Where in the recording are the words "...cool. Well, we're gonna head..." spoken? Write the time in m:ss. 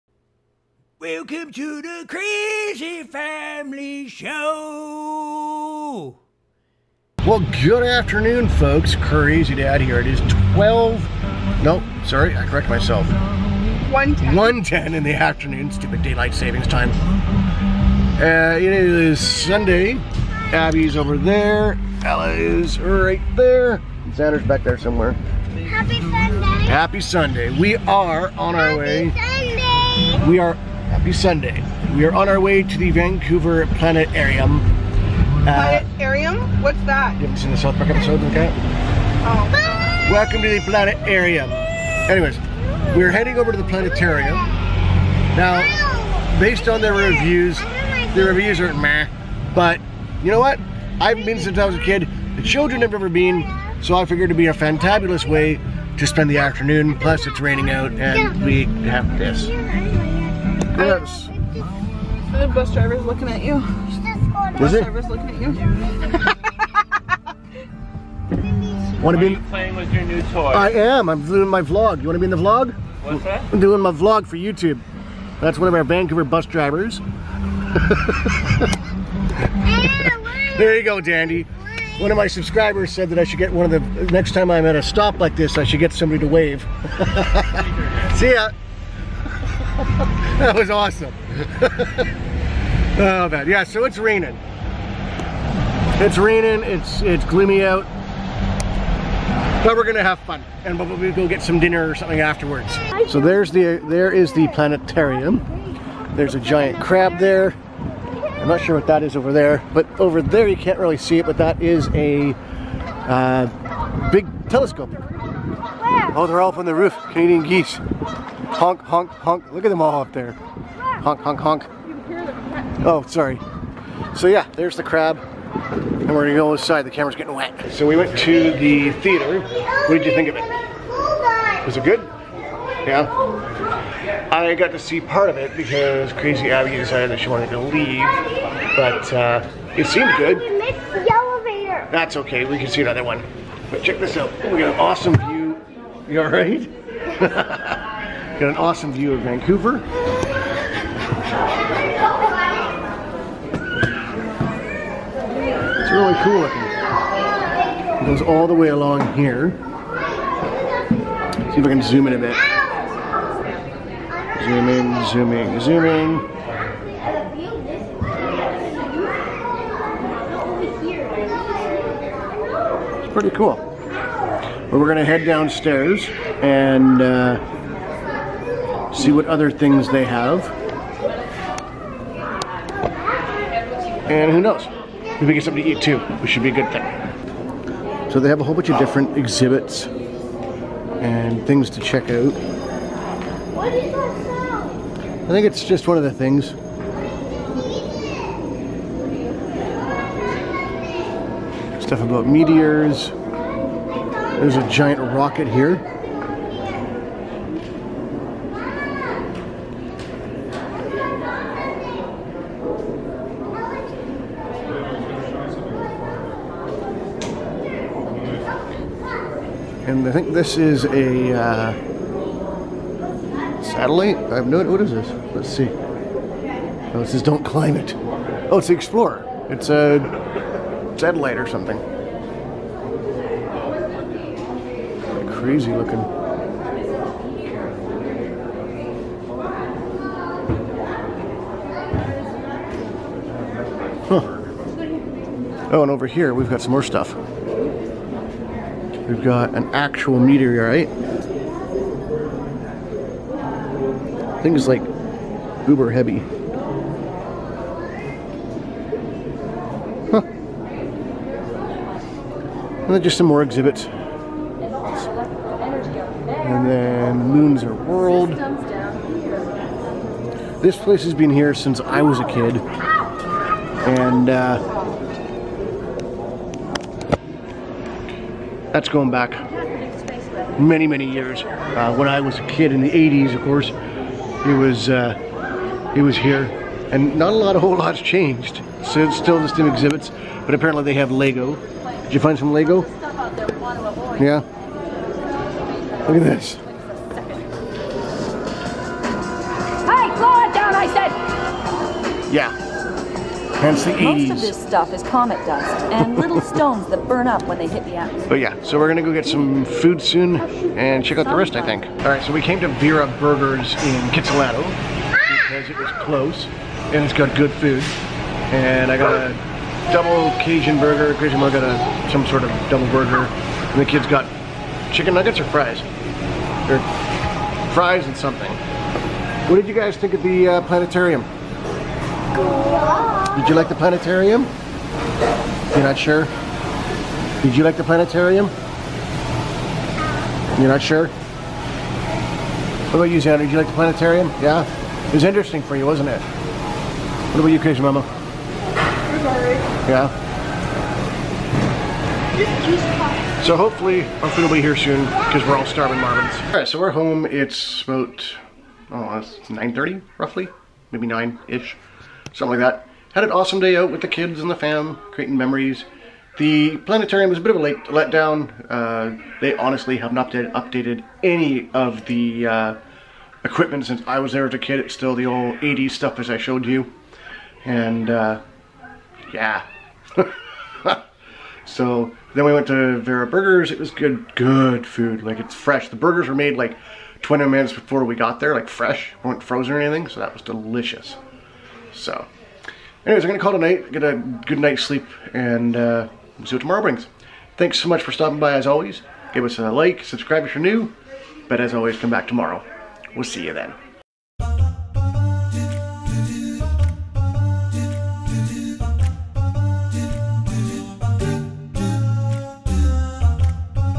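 2:53.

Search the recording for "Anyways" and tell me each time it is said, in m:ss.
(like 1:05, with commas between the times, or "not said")
0:41, 6:33.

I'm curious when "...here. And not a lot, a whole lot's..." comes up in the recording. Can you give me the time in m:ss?
4:46.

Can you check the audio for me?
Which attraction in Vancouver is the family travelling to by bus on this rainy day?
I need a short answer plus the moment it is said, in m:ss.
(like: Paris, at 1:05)
Vancouver Planetarium, at 0:32.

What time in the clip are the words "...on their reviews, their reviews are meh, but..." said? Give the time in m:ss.
0:46.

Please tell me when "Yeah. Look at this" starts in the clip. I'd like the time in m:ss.
4:54.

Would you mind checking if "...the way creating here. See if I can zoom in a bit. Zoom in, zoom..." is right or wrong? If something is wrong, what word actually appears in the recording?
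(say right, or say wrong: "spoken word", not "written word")
wrong: "along", not "creating".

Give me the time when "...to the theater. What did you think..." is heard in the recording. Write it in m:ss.
2:08.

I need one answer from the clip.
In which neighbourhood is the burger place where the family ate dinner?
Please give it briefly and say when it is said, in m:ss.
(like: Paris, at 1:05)
Kitsilano, at 5:14.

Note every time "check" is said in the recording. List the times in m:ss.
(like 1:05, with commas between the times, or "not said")
2:23, 3:11, 5:11.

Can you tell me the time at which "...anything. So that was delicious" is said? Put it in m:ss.
6:29.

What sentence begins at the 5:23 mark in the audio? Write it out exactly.
And the kids got chicken nuggets or fries?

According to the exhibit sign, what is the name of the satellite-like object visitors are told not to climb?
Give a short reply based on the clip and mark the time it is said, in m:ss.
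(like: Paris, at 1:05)
Explorer, at 3:48.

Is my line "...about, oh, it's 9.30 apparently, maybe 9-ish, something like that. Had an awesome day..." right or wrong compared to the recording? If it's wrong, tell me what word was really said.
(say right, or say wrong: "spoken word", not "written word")
wrong: "roughly", not "apparently".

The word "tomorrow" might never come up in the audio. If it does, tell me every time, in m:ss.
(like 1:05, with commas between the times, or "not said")
6:36, 6:42.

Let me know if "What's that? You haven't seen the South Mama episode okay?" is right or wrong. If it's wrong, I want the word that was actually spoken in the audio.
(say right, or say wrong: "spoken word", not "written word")
wrong: "Park", not "Mama".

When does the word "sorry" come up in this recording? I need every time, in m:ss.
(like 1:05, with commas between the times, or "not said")
0:12, 2:03.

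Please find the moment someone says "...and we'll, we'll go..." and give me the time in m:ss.
1:40.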